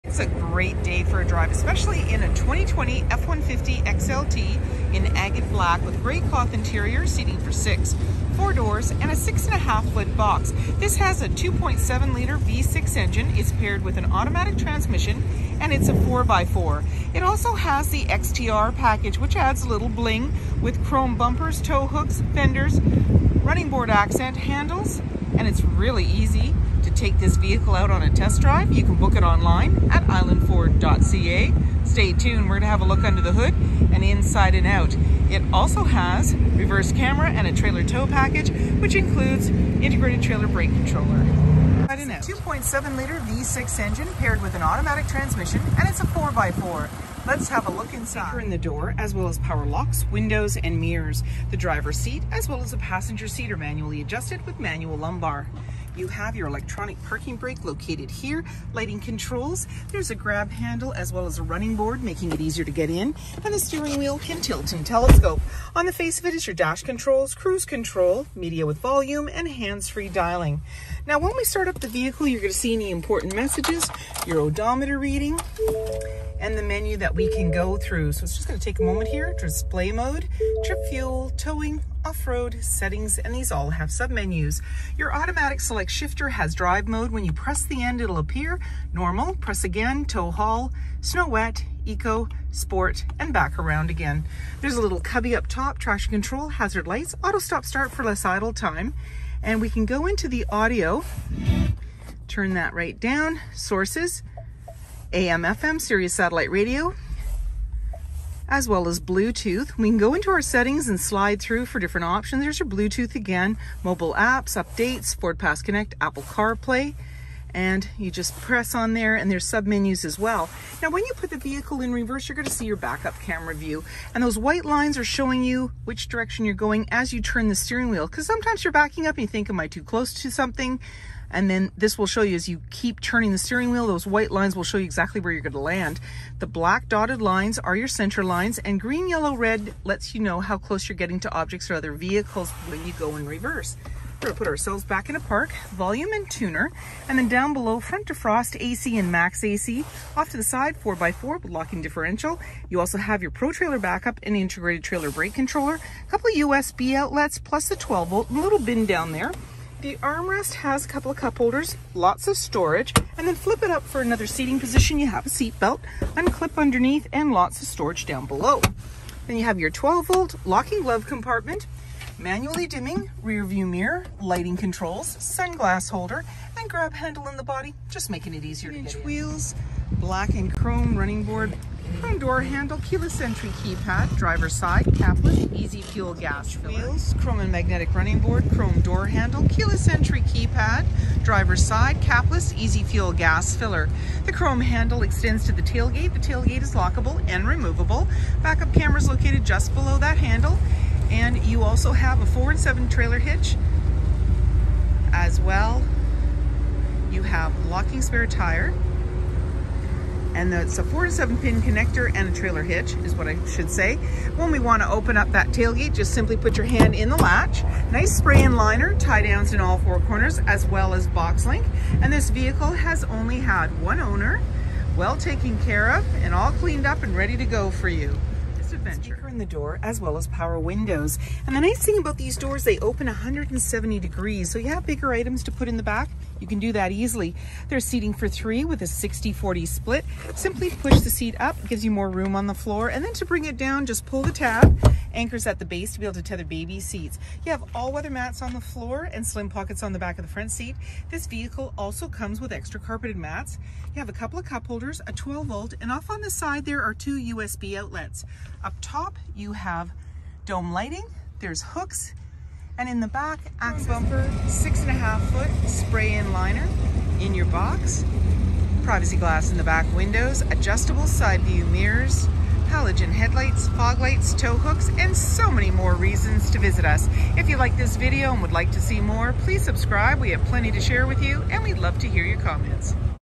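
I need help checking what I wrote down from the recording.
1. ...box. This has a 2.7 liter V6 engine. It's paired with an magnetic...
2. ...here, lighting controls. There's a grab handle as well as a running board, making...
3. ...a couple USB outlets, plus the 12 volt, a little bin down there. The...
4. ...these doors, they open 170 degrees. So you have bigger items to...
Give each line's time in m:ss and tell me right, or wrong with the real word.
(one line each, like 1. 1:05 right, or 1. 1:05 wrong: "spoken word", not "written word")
1. 0:10 wrong: "automatic", not "magnetic"
2. 0:58 right
3. 2:36 right
4. 3:52 right.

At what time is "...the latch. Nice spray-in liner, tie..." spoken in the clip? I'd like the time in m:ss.
3:37.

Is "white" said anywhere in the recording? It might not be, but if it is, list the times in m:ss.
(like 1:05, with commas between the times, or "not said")
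2:04, 2:14.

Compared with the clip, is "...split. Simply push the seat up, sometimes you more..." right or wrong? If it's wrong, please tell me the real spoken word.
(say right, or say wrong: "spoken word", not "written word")
wrong: "gives", not "sometimes".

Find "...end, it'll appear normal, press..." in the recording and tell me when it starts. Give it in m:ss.
1:27.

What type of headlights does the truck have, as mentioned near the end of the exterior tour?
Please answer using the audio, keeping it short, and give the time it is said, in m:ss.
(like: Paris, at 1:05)
halogen, at 4:32.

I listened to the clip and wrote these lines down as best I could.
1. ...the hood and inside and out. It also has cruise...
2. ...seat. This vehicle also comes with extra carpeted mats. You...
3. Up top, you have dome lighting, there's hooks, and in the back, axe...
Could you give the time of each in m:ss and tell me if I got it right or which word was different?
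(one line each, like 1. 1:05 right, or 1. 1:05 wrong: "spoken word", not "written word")
1. 0:33 wrong: "reverse", not "cruise"
2. 4:10 right
3. 4:18 right.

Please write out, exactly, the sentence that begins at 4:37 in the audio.
If you like this video and would like to see more, please subscribe.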